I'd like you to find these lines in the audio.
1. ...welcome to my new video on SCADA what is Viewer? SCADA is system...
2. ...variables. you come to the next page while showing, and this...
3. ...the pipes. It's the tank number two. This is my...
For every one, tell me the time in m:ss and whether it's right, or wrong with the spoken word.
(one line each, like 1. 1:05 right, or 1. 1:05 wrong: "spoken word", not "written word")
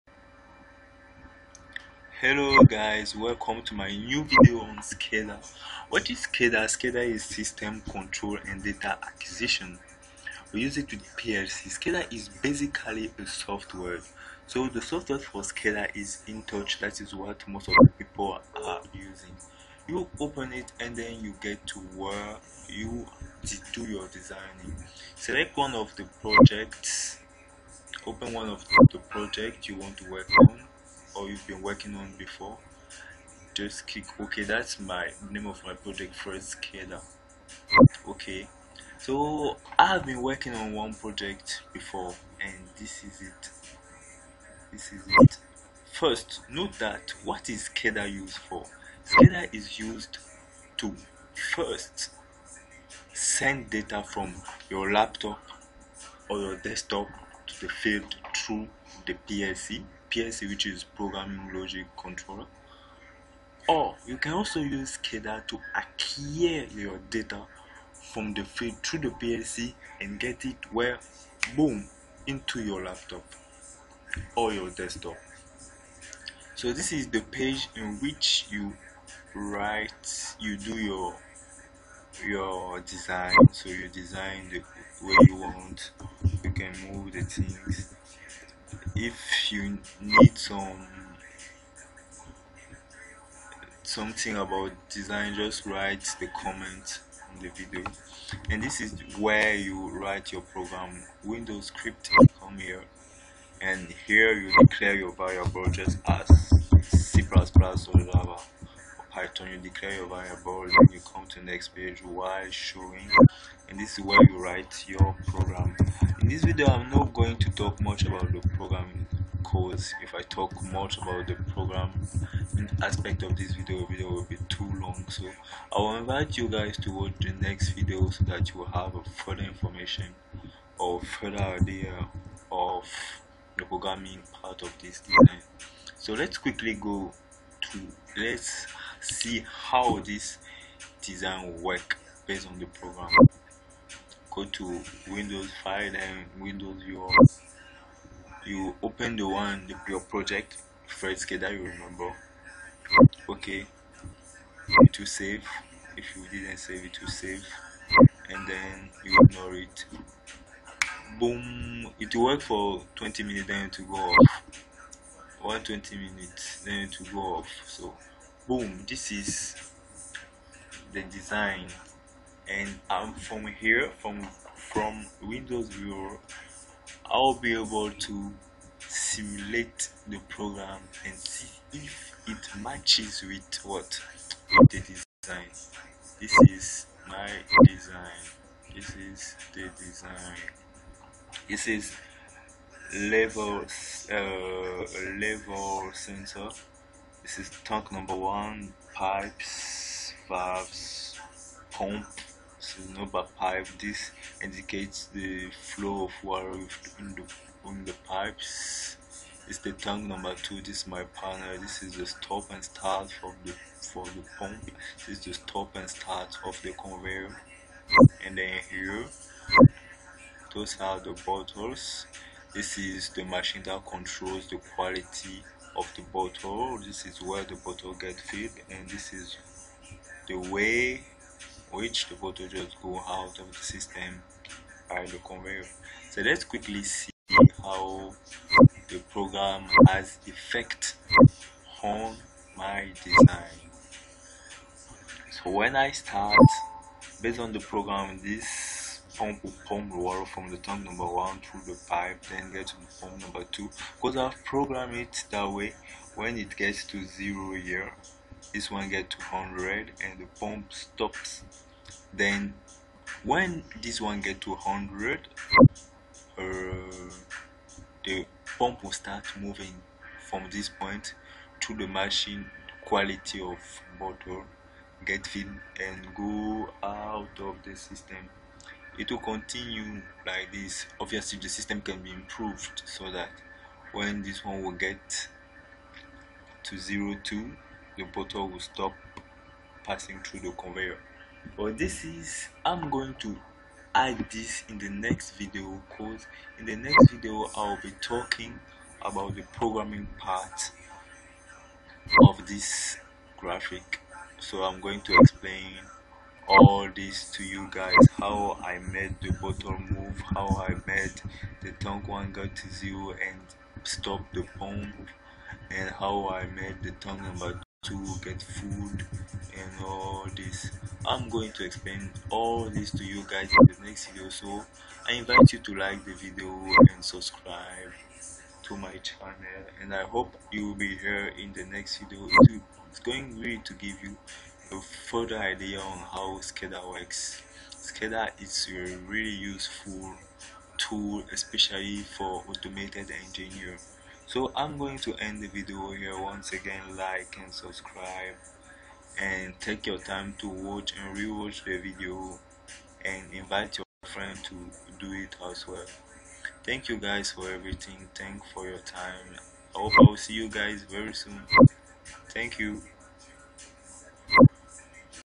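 1. 0:03 wrong: "SCADA", not "Viewer"
2. 1:50 right
3. 3:27 right.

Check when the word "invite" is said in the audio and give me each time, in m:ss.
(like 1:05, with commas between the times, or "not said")
2:05, 5:25, 5:53.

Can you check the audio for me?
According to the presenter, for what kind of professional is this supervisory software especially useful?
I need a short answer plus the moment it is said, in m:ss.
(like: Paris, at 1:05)
automated engineer, at 5:42.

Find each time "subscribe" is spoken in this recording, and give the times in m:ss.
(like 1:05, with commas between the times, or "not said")
5:27, 5:47.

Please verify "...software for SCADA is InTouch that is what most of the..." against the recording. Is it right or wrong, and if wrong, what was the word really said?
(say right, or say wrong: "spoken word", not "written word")
right.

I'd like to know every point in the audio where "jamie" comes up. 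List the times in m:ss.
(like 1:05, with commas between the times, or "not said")
not said.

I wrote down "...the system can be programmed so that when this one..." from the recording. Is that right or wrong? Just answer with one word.
wrong.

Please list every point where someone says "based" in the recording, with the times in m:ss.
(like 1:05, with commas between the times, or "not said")
2:22, 4:07.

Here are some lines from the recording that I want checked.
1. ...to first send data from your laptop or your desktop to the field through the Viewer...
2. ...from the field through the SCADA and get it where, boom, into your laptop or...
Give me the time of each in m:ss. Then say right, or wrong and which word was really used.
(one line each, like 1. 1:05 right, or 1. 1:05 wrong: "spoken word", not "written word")
1. 0:50 wrong: "PLC", not "Viewer"
2. 1:08 wrong: "PLC", not "SCADA".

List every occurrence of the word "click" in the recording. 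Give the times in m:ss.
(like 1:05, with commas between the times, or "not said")
0:33.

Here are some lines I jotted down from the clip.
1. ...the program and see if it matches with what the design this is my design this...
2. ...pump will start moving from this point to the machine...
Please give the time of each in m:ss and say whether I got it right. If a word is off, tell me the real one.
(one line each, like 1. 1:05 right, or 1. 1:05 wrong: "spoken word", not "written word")
1. 3:00 right
2. 4:28 right.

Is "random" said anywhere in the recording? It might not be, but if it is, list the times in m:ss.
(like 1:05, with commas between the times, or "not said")
not said.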